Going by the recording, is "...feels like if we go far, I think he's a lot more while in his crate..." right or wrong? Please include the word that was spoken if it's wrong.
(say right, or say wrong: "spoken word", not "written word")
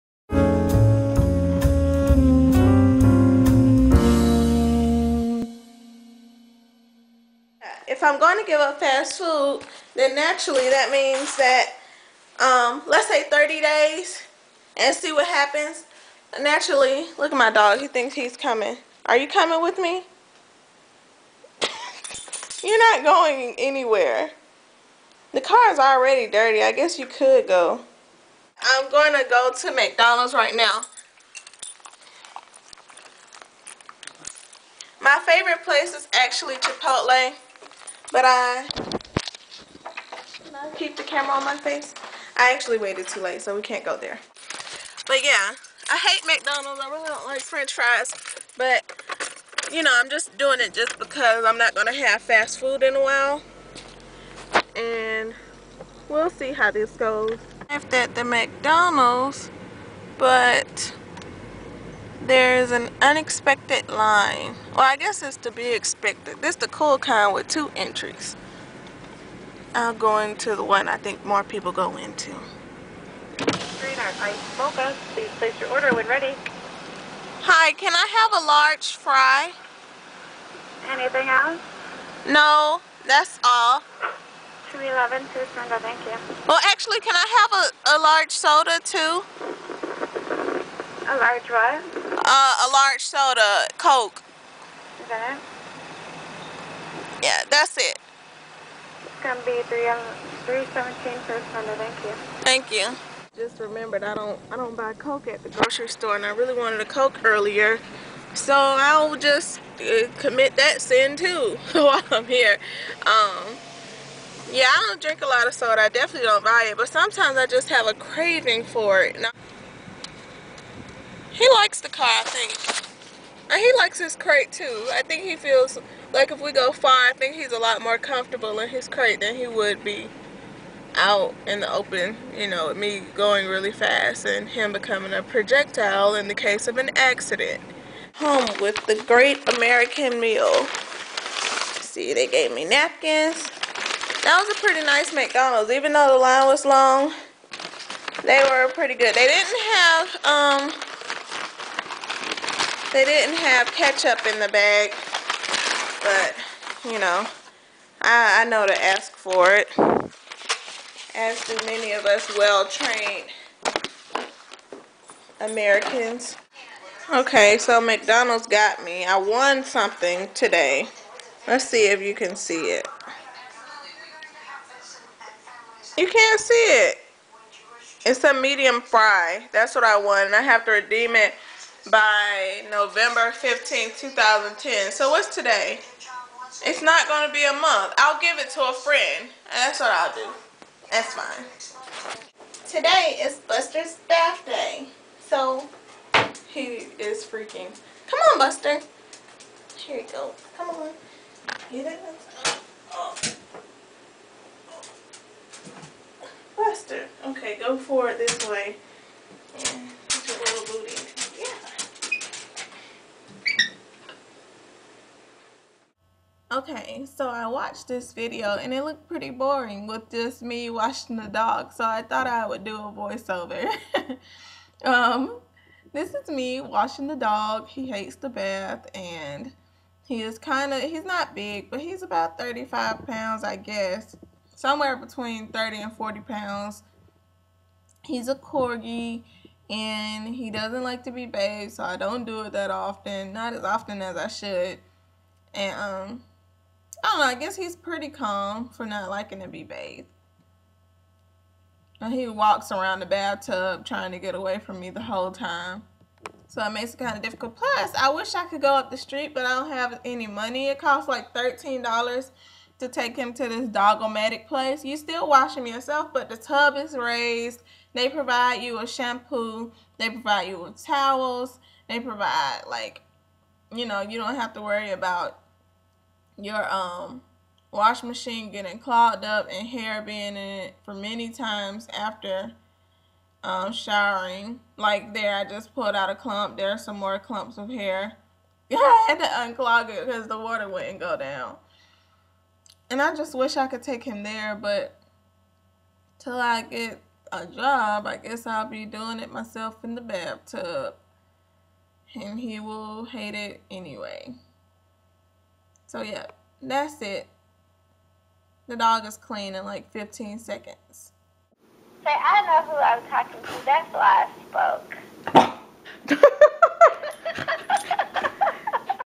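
wrong: "comfortable", not "while".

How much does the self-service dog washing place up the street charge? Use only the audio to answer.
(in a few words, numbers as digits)
$13.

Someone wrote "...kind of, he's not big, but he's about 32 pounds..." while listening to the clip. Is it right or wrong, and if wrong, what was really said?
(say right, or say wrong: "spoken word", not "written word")
wrong: "35", not "32".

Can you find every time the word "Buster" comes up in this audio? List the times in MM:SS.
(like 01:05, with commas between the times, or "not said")
03:13, 03:18, 03:26.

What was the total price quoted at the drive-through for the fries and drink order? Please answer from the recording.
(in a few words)
3.17.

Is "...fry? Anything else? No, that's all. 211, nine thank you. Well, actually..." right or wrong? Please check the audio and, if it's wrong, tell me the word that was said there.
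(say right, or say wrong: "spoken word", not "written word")
wrong: "two", not "nine".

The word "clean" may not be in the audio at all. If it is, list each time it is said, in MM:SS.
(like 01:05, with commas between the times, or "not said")
05:09.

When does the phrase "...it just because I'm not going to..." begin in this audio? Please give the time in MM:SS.
00:50.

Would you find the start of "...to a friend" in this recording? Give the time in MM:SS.
03:08.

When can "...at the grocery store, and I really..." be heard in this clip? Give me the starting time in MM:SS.
01:45.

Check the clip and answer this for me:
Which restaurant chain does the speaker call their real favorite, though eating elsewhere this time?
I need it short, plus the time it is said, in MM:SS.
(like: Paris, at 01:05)
Chipotle, at 00:36.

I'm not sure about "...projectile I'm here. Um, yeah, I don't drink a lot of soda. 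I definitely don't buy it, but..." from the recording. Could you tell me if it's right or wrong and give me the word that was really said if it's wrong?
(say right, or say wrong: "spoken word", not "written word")
wrong: "while", not "projectile".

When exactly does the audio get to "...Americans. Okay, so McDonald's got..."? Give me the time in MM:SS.
02:45.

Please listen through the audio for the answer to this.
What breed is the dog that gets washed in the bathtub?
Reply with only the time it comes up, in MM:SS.
03:58.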